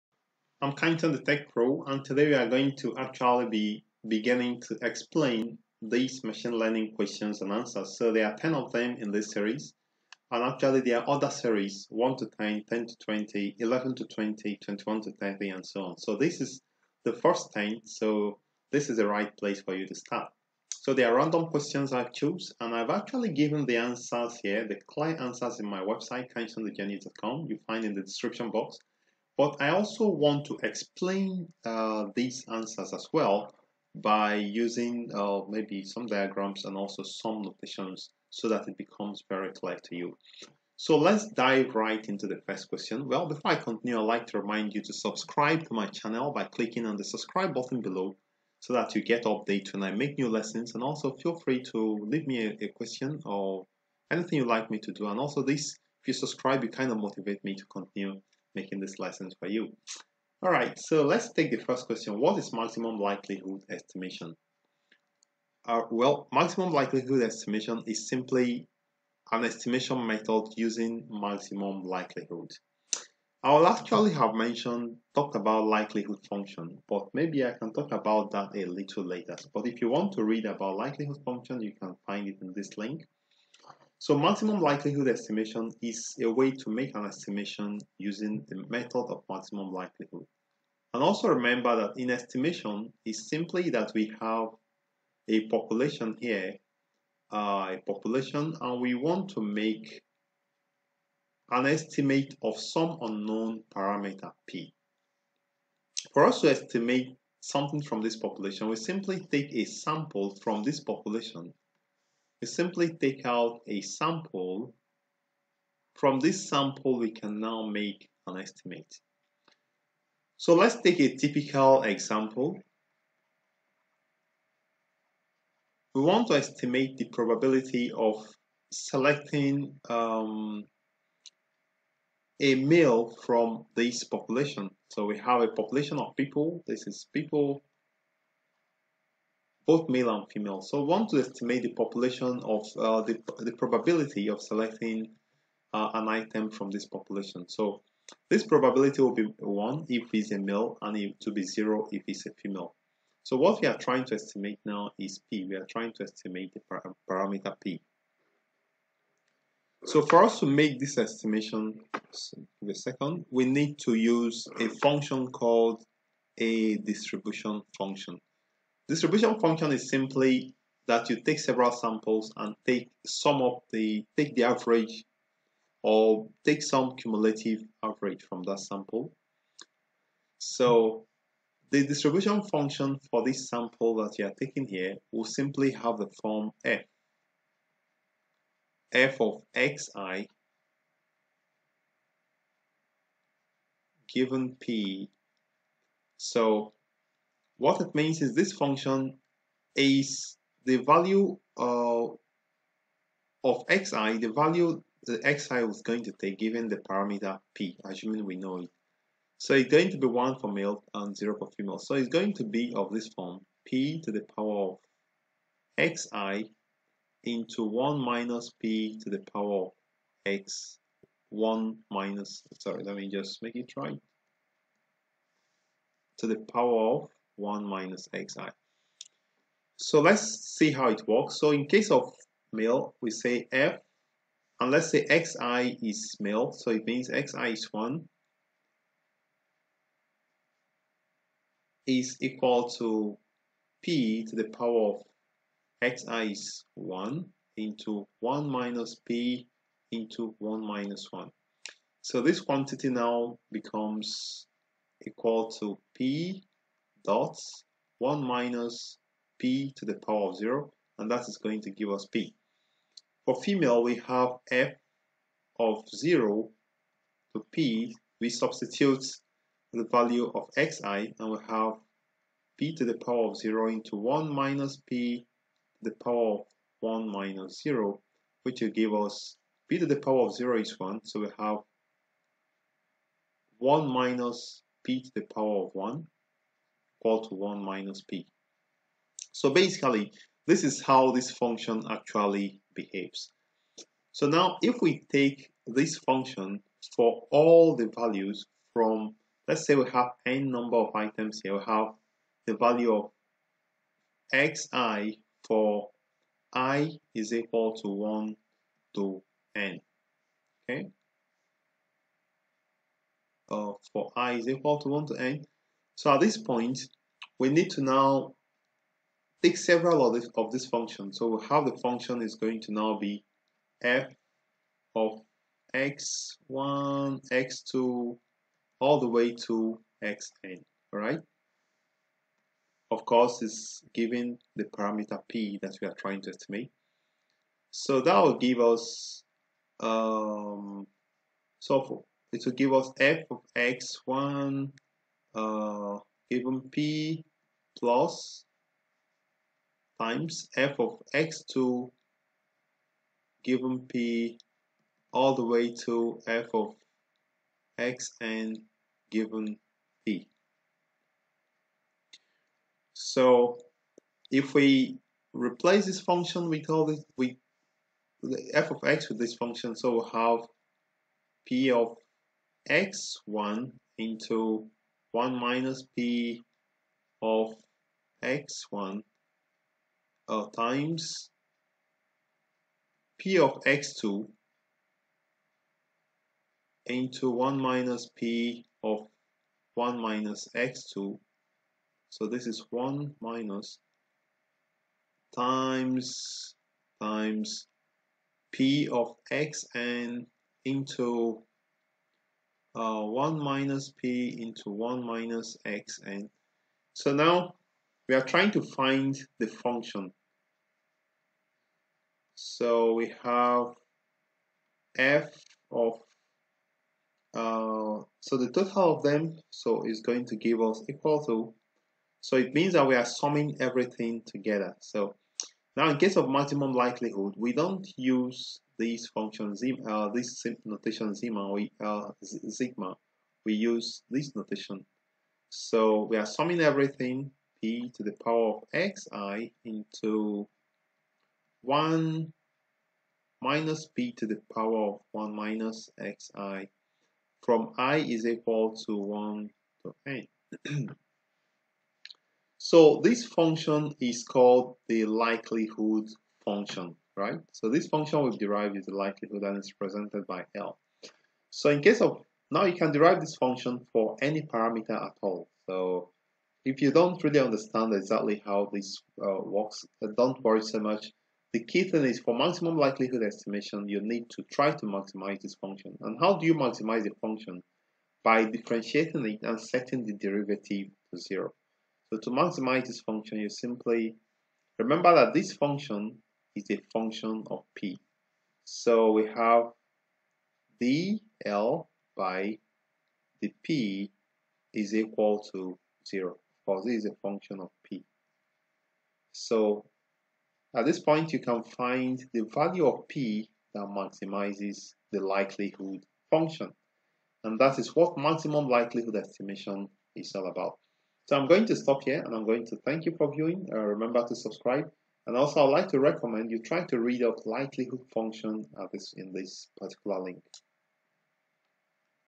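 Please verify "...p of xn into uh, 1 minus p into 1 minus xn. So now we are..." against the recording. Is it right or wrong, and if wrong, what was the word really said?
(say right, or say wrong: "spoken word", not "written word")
right.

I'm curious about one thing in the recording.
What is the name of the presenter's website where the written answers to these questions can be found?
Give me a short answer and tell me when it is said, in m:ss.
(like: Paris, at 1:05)
kindsonthegenius.com, at 0:26.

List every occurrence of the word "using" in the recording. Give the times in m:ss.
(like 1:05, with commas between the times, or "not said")
0:34, 1:10, 1:27.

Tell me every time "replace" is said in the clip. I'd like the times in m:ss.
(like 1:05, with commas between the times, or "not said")
6:05.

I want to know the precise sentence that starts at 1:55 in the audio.
From this sample, we can now make an estimate.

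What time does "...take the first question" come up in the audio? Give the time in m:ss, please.
1:01.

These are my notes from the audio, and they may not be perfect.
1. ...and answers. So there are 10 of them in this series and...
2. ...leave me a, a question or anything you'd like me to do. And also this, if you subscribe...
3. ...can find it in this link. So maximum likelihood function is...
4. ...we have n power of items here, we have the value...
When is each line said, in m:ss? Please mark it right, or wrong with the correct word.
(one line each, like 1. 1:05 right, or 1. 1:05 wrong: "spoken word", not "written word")
1. 0:07 right
2. 0:52 right
3. 1:21 wrong: "estimation", not "function"
4. 4:59 wrong: "number", not "power".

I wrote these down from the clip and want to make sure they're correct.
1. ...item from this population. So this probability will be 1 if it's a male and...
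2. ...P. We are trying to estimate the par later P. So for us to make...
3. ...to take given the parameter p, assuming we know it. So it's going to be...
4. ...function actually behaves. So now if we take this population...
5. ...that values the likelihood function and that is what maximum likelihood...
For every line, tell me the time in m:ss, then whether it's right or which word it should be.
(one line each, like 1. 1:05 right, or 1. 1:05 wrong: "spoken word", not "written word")
1. 2:26 right
2. 2:35 wrong: "parameter", not "later"
3. 3:26 right
4. 4:51 wrong: "function", not "population"
5. 8:23 wrong: "maximizes", not "values".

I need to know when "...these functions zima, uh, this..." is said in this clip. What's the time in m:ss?
7:08.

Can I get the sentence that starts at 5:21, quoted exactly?
So how the function is going to now be f of x1, x2, all the way to xn, all right?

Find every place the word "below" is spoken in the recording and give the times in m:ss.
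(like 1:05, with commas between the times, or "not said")
0:47.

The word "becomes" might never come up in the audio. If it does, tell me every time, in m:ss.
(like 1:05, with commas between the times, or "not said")
0:38, 4:13.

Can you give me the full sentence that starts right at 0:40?
So let's dive right into the first question.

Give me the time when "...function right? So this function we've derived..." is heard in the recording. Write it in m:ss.
7:36.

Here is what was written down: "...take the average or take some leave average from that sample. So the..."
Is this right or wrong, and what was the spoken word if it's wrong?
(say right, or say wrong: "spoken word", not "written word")
wrong: "cumulative", not "leave".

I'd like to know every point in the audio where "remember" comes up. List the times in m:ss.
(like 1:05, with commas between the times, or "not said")
1:31, 8:04, 8:33.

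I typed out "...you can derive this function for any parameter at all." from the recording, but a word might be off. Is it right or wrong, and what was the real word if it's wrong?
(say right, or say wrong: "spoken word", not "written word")
right.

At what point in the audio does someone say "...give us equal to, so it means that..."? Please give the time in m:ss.
7:00.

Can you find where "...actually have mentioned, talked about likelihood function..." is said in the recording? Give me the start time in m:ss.
1:13.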